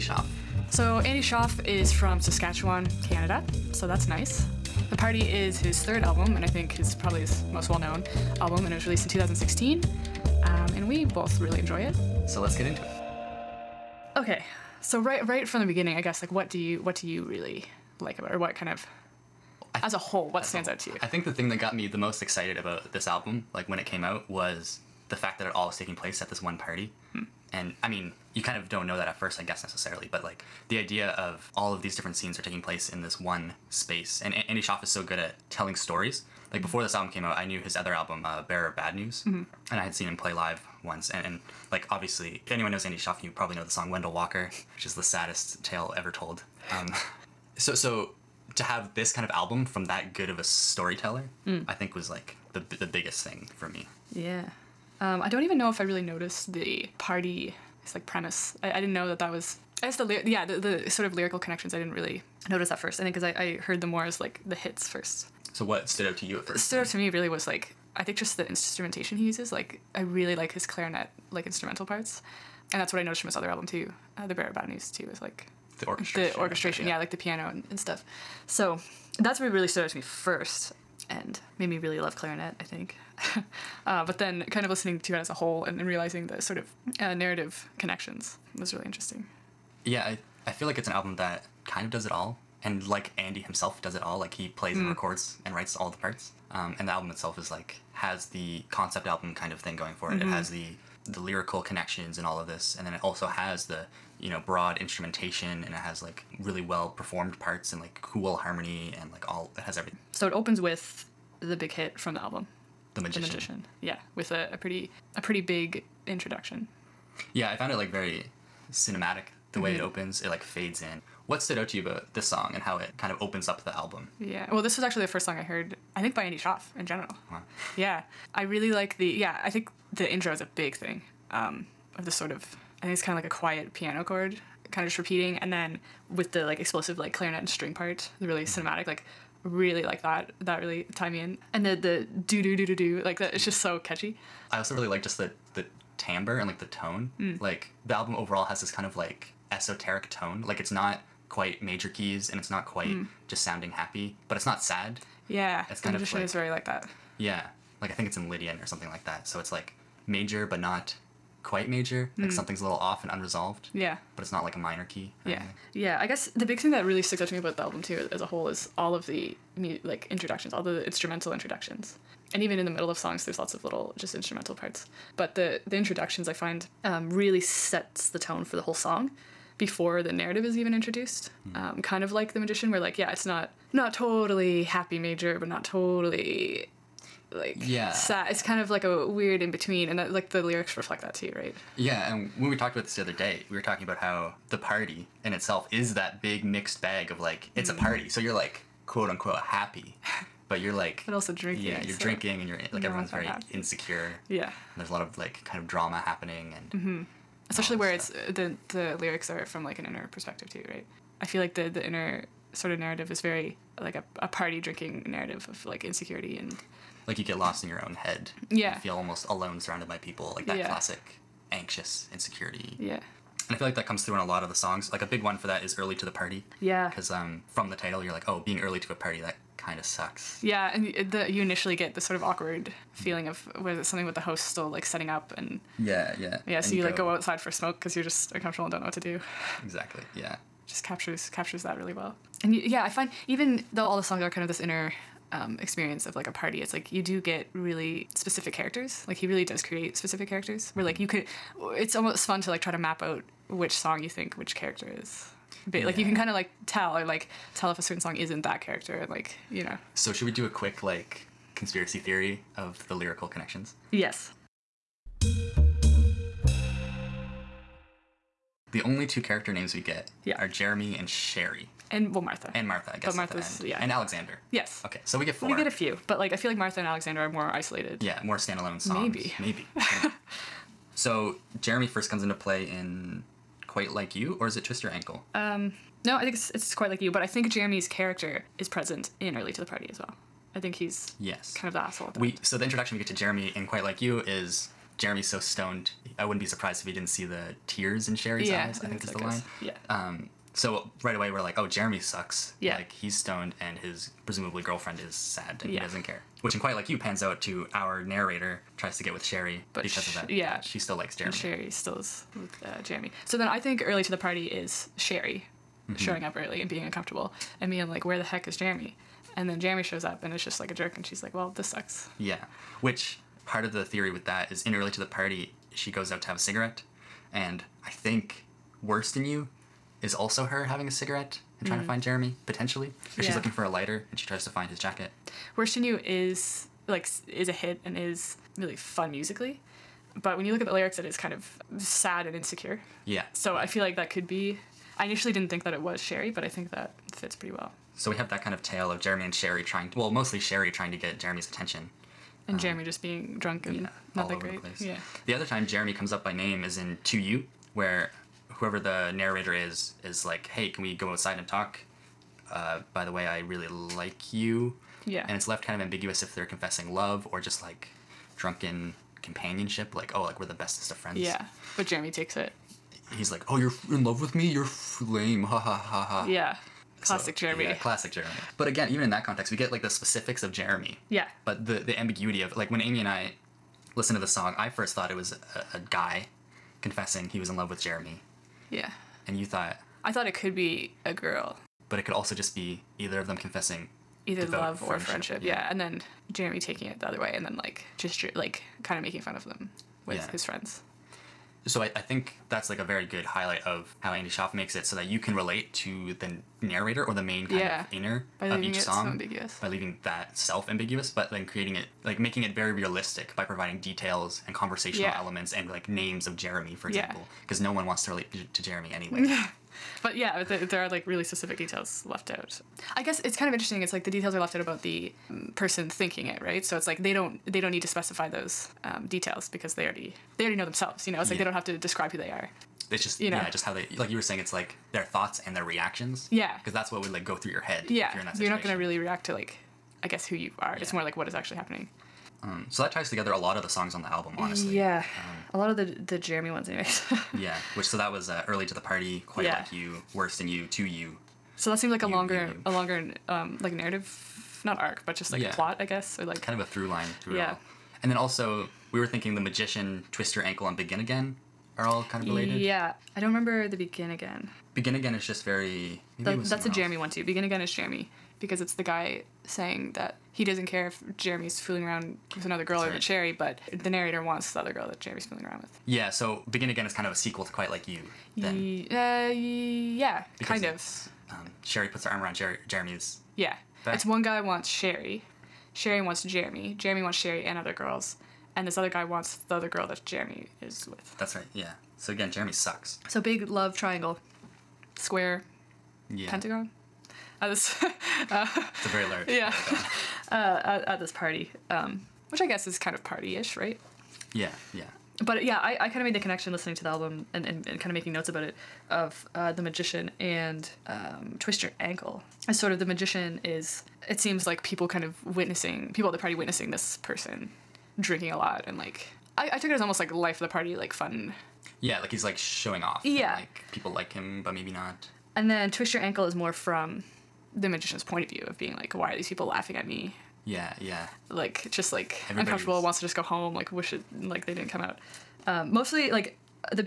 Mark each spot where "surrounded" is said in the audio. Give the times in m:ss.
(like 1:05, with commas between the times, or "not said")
3:39.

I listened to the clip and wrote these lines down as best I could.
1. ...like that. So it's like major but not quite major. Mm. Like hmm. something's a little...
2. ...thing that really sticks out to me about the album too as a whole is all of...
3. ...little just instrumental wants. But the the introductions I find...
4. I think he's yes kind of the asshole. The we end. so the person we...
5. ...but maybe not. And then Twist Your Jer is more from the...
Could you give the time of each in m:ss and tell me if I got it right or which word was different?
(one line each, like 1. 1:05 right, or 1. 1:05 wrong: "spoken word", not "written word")
1. 2:38 right
2. 2:46 right
3. 2:53 wrong: "parts", not "wants"
4. 4:50 wrong: "introduction", not "person"
5. 8:44 wrong: "Ankle", not "Jer".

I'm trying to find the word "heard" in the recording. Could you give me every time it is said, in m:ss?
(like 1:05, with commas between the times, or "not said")
1:03, 2:05.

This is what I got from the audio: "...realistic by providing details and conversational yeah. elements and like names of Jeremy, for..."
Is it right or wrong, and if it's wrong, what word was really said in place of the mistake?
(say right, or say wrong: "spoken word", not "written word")
right.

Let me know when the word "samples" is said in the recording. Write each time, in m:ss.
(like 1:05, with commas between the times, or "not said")
not said.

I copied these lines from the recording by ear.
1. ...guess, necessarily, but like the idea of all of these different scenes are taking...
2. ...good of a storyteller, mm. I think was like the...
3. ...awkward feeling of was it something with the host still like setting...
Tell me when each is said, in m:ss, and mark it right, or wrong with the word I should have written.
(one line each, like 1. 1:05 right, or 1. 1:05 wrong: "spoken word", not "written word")
1. 0:29 right
2. 0:50 right
3. 3:52 right.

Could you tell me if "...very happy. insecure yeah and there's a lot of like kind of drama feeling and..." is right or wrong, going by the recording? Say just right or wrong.
wrong.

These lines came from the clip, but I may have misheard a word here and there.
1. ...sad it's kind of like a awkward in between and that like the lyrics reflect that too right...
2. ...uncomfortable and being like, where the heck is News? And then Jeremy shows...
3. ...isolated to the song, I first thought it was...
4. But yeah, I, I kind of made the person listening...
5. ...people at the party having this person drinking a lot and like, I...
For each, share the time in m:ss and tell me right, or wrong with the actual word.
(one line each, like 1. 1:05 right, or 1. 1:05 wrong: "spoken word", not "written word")
1. 3:07 wrong: "weird", not "awkward"
2. 5:16 wrong: "Jeremy", not "News"
3. 6:23 wrong: "listened", not "isolated"
4. 8:25 wrong: "connection", not "person"
5. 8:35 wrong: "witnessing", not "having".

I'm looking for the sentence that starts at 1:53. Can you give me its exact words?
yeah with a, a pretty a pretty big introduction yeah i found it like very cinematic the mm-hmm.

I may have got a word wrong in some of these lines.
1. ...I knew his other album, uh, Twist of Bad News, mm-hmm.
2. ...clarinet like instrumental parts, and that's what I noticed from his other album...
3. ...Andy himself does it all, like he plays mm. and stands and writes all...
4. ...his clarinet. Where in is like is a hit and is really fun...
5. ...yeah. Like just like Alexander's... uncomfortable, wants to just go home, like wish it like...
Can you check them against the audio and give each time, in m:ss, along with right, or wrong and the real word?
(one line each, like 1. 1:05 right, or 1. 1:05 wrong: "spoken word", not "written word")
1. 0:37 wrong: "Bearer", not "Twist"
2. 1:10 right
3. 1:33 wrong: "records", not "stands"
4. 5:34 wrong: "jacket", not "clarinet"
5. 8:50 wrong: "Everybody", not "Alexander".